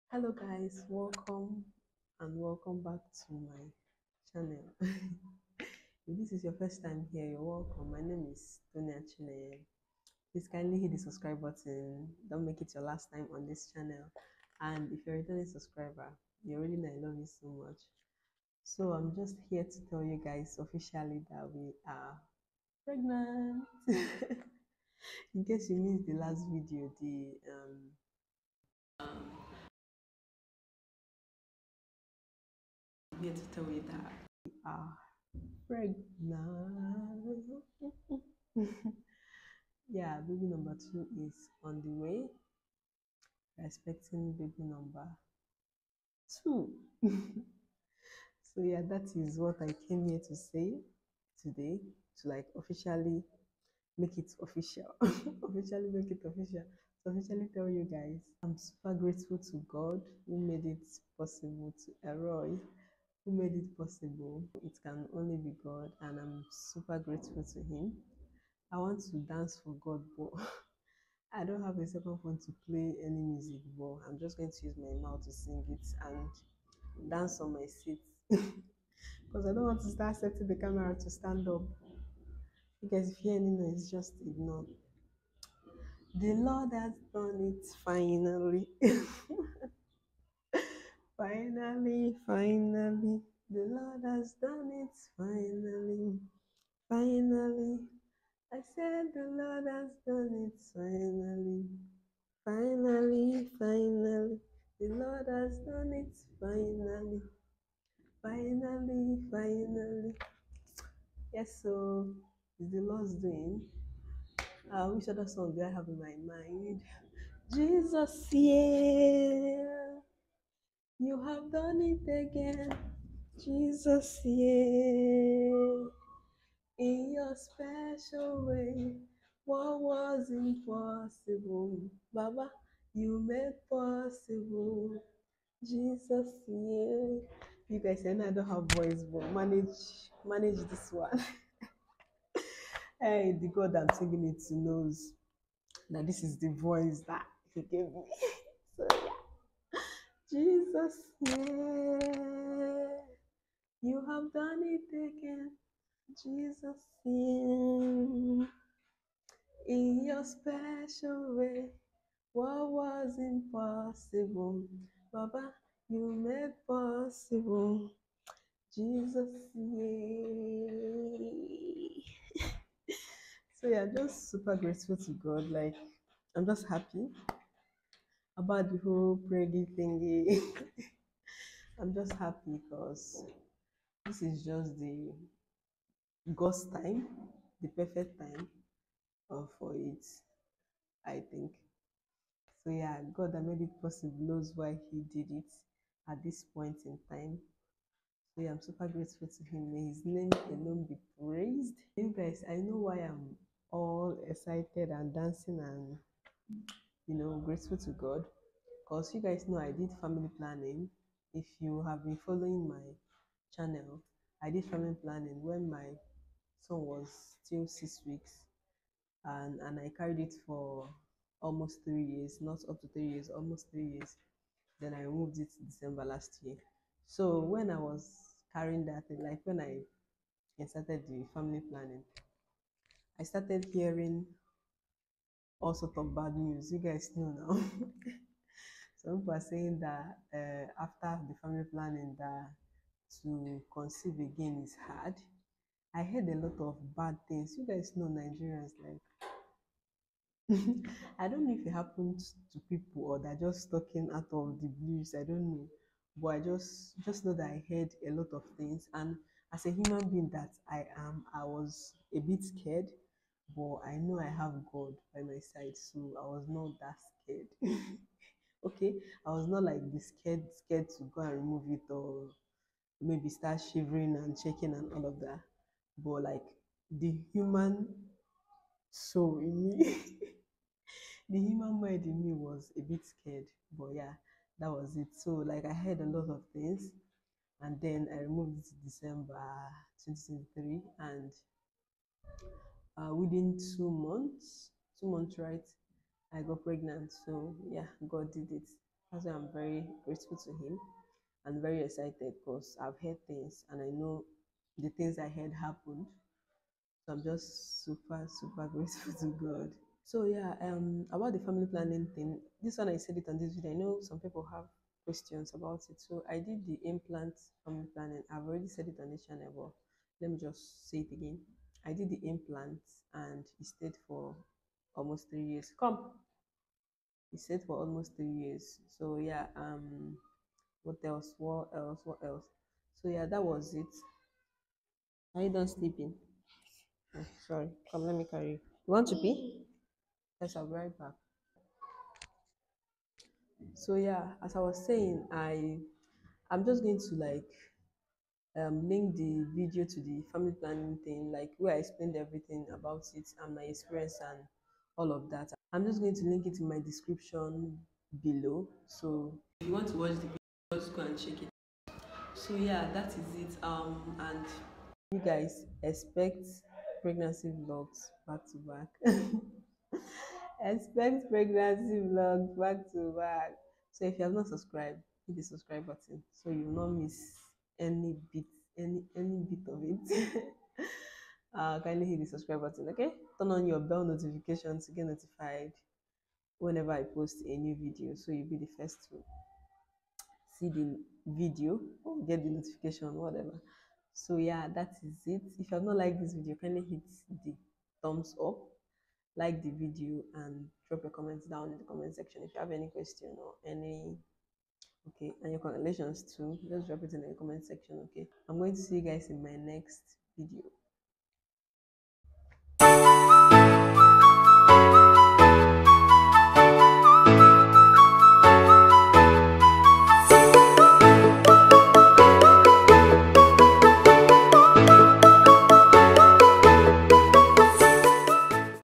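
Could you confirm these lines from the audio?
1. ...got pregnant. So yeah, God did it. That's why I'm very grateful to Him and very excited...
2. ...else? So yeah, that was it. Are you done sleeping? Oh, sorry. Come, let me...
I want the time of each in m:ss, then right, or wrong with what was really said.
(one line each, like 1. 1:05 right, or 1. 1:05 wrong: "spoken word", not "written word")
1. 4:56 right
2. 5:32 right.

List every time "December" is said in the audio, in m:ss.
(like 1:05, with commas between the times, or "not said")
3:45, 4:48.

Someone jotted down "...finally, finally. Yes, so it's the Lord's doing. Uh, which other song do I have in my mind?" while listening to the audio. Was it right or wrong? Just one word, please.
right.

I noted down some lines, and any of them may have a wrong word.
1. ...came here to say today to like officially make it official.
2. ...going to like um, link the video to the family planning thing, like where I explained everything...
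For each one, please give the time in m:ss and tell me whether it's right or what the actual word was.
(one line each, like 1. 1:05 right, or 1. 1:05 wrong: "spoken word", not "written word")
1. 0:49 right
2. 5:46 right.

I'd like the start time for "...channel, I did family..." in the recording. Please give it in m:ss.
3:33.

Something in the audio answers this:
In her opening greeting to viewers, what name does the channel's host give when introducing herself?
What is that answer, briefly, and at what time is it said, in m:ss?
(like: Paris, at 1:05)
Tonia Chine, at 0:08.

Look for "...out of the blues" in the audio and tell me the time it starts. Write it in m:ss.
4:14.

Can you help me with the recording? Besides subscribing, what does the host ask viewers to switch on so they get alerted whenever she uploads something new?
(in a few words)
Bell notification.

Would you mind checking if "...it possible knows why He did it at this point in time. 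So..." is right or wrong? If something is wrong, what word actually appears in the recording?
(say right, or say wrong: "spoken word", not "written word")
right.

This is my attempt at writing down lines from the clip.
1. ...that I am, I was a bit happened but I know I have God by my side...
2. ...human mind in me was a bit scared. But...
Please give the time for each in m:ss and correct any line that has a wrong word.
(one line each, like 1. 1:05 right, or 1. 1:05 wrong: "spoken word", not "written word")
1. 4:20 wrong: "scared", not "happened"
2. 4:41 right.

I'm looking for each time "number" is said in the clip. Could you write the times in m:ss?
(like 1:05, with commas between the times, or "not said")
0:40, 0:44.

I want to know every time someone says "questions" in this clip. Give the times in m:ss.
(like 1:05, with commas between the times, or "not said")
5:15, 6:42.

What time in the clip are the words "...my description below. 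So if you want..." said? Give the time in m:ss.
5:56.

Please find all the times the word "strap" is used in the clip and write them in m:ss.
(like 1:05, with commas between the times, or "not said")
not said.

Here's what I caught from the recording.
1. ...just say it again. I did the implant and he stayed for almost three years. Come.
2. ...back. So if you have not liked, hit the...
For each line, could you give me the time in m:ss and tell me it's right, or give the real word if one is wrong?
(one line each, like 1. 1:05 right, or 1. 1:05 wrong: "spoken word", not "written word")
1. 5:20 right
2. 6:13 wrong: "subscribed", not "liked".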